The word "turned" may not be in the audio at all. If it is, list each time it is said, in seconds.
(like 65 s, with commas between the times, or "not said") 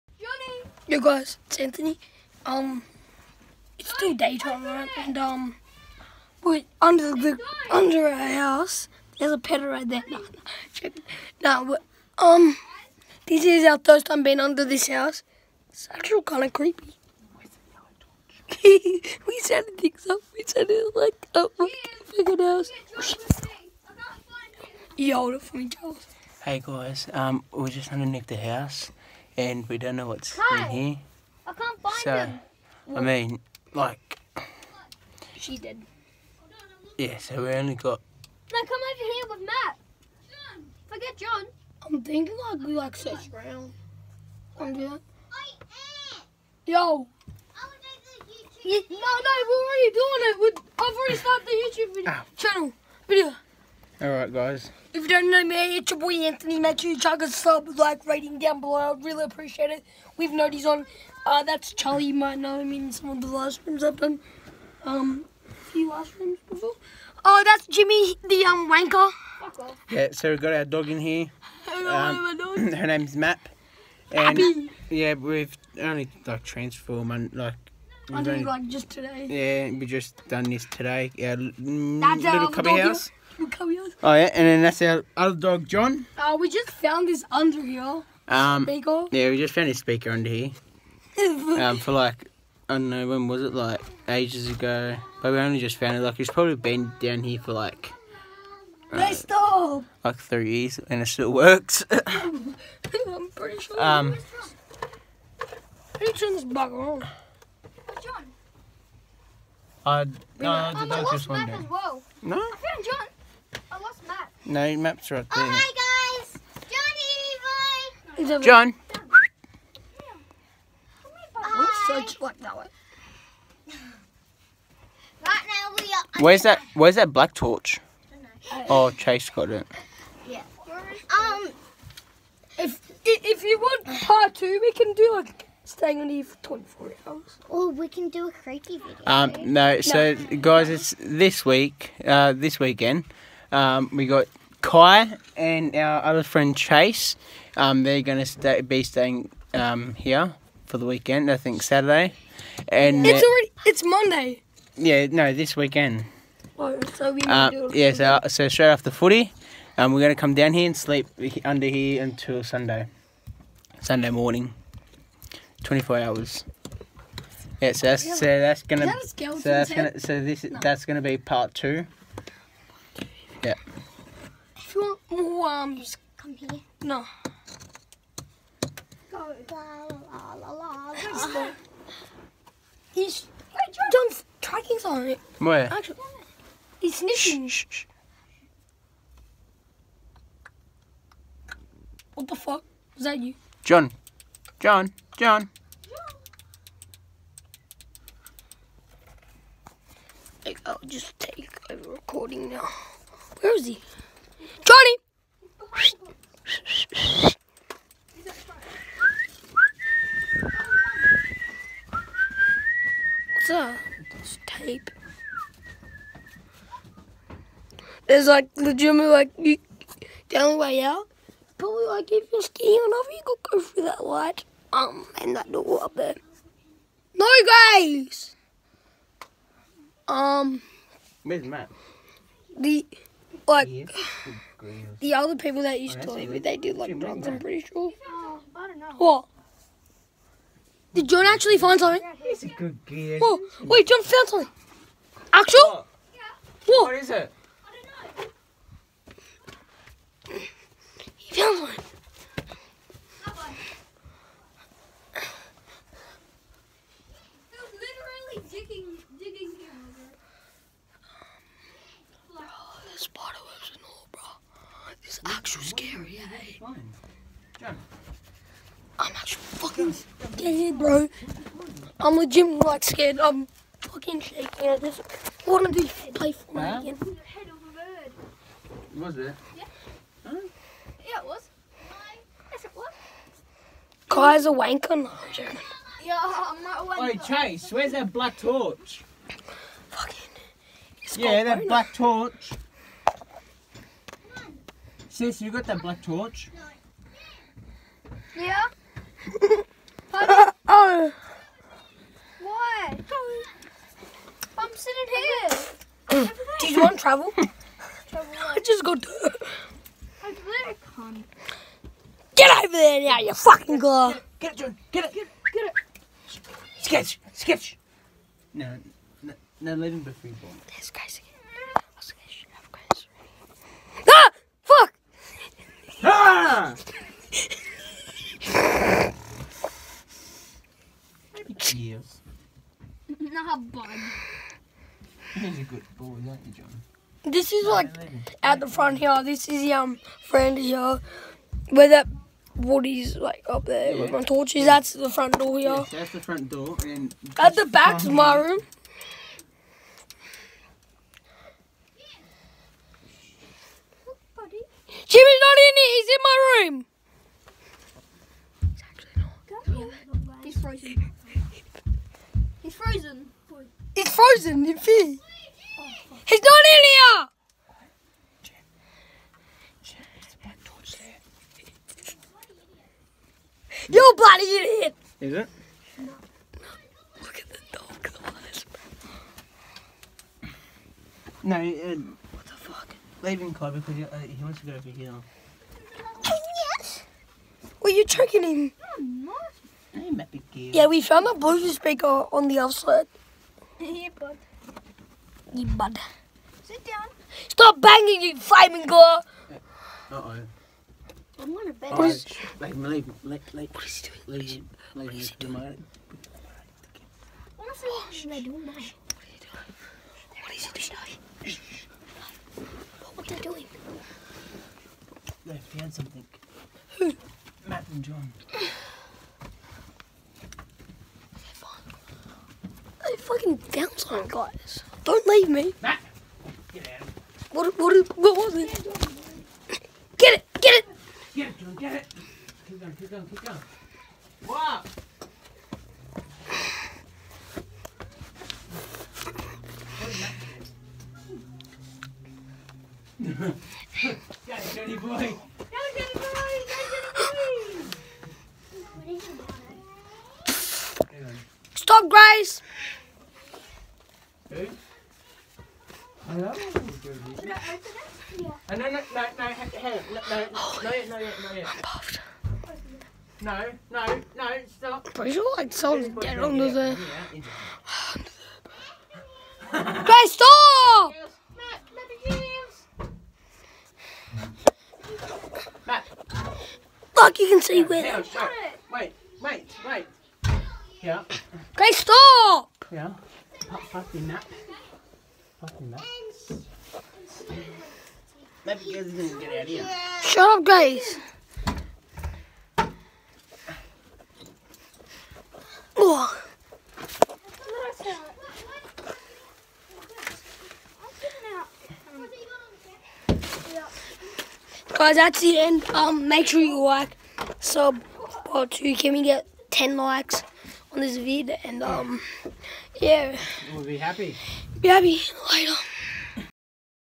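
106 s.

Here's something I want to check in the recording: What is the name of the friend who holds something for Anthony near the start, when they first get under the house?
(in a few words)
Charles.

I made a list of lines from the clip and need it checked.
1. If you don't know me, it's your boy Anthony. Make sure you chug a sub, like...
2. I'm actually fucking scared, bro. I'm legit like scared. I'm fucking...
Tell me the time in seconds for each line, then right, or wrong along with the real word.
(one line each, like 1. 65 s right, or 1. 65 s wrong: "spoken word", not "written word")
1. 54 s right
2. 268 s right.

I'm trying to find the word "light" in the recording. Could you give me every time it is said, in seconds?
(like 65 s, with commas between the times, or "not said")
224 s, 515 s.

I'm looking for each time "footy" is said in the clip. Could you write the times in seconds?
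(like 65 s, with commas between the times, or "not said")
158 s.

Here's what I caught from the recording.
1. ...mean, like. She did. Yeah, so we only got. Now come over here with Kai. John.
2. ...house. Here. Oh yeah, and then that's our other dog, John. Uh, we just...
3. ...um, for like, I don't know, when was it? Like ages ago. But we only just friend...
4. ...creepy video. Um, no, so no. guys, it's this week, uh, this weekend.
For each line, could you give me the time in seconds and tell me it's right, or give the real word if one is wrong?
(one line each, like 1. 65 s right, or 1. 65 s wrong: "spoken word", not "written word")
1. 33 s wrong: "Matt", not "Kai"
2. 82 s right
3. 91 s wrong: "found", not "friend"
4. 138 s right.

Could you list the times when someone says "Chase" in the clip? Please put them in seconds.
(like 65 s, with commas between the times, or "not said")
128 s, 146 s, 287 s.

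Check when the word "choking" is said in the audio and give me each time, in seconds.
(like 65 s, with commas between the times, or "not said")
388 s.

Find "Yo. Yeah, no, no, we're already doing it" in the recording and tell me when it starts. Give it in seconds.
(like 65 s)
46 s.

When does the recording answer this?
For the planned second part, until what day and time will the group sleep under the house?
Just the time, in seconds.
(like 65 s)
163 s.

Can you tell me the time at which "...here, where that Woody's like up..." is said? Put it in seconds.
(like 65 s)
340 s.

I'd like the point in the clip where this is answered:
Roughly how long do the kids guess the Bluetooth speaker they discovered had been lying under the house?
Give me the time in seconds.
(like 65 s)
100 s.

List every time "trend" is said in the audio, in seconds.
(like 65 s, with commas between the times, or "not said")
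not said.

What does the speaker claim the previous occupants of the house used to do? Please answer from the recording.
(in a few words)
drugs.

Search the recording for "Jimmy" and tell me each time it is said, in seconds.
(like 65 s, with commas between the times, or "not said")
67 s, 355 s.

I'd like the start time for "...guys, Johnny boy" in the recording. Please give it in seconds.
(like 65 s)
116 s.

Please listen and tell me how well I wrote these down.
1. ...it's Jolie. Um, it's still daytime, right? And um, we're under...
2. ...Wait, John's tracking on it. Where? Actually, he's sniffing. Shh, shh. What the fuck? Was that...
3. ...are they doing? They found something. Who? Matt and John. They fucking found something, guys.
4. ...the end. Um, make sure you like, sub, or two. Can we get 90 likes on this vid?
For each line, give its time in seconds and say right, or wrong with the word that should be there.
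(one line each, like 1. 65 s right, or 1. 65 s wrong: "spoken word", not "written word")
1. 1 s wrong: "Anthony", not "Jolie"
2. 183 s right
3. 413 s right
4. 505 s wrong: "10", not "90".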